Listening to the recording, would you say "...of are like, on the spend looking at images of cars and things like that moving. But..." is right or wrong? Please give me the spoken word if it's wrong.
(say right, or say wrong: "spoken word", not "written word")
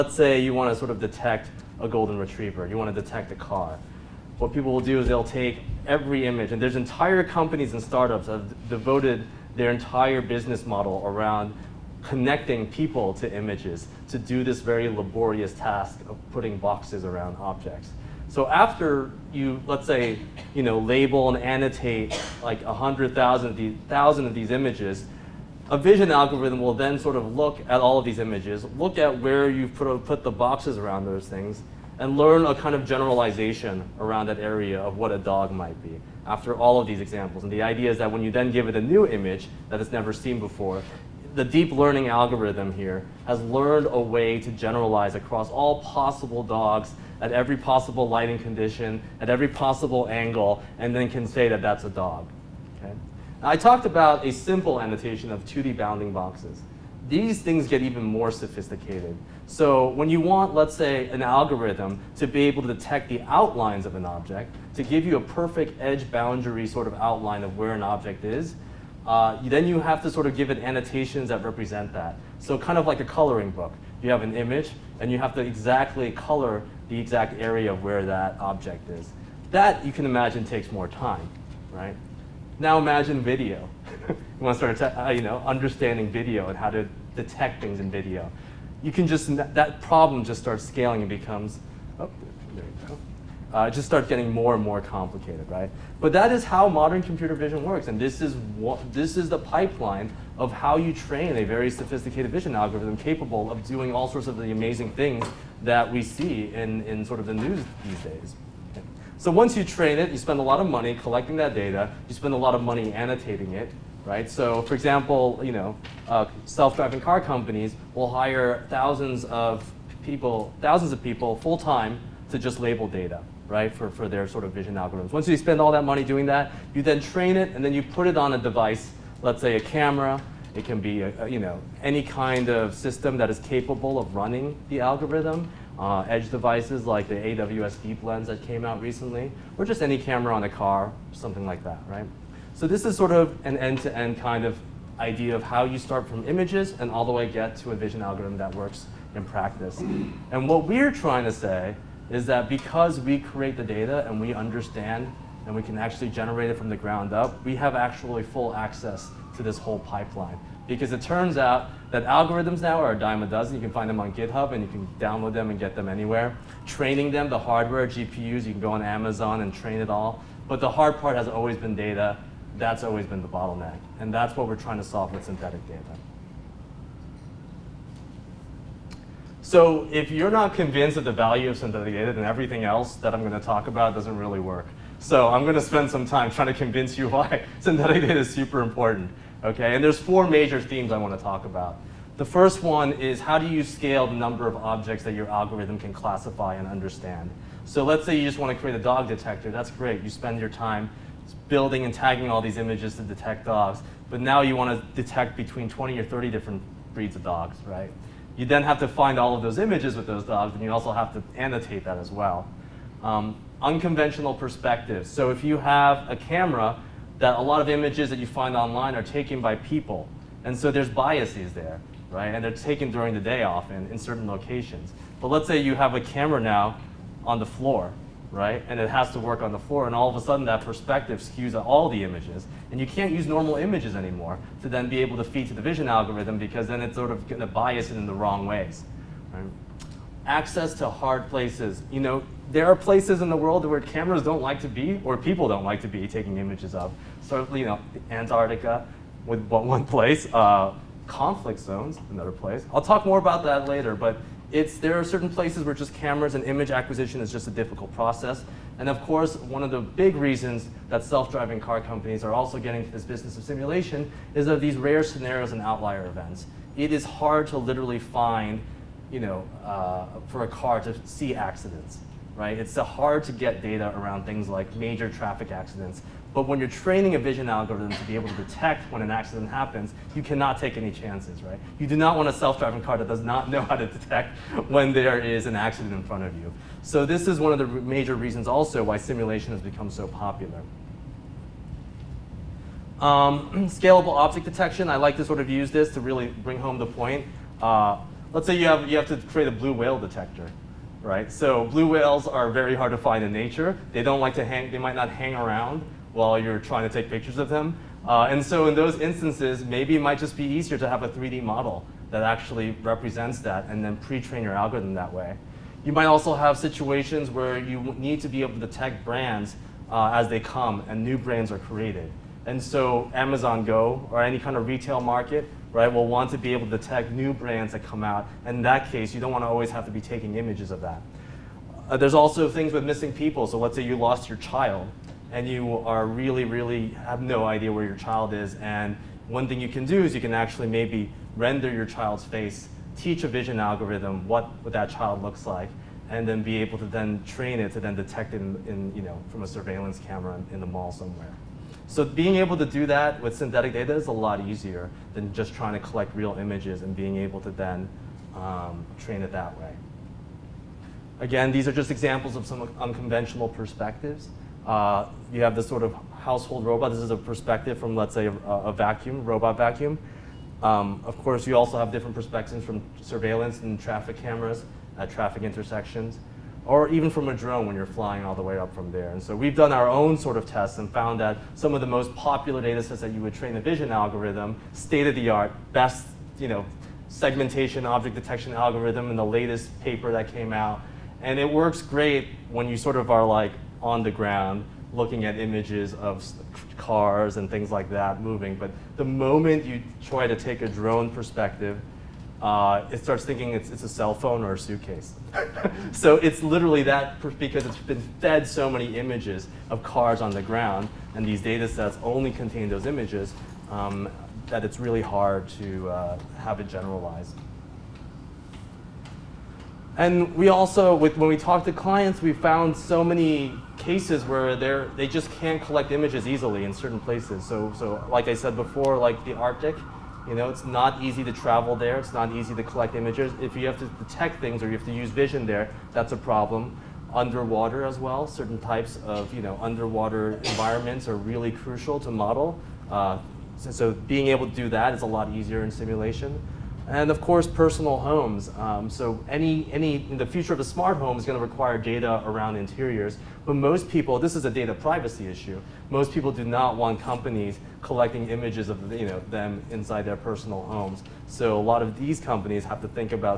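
wrong: "ground", not "spend".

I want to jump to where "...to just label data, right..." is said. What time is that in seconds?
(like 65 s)
122 s.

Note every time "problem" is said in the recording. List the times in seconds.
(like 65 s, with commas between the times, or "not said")
89 s, 436 s.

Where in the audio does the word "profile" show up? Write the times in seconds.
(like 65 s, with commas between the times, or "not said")
not said.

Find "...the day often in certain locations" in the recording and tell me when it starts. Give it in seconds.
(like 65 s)
223 s.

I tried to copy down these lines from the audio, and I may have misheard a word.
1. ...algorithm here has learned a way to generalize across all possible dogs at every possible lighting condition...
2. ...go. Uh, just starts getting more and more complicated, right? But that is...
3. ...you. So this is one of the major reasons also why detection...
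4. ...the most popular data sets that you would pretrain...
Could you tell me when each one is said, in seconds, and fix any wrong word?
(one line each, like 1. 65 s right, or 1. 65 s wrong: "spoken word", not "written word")
1. 42 s right
2. 92 s right
3. 286 s wrong: "simulation", not "detection"
4. 381 s wrong: "train", not "pretrain".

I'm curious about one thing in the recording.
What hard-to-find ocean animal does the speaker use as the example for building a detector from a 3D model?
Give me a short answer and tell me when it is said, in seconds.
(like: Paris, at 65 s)
Blue whale, at 299 s.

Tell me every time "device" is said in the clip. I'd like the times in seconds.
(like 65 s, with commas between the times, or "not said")
128 s, 136 s.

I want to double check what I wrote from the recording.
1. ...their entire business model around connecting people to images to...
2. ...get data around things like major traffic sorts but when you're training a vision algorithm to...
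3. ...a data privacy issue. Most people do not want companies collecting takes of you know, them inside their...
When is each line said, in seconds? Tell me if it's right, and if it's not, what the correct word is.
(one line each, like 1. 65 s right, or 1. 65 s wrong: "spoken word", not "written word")
1. 9 s right
2. 273 s wrong: "accidents", not "sorts"
3. 454 s wrong: "images", not "takes".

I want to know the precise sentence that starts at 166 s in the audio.
Training them, the hardware, GPUs, you can go on Amazon and train it all.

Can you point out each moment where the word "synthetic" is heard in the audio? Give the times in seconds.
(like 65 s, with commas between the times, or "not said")
175 s, 181 s, 187 s, 353 s.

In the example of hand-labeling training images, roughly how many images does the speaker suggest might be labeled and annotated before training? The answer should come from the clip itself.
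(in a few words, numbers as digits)
100,000.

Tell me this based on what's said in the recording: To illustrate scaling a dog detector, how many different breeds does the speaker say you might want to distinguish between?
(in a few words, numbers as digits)
20 or 30.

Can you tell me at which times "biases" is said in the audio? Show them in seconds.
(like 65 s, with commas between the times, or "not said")
220 s.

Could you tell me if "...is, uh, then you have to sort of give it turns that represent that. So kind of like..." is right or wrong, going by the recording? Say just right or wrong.
wrong.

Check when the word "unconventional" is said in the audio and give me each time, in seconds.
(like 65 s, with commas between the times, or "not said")
213 s, 362 s.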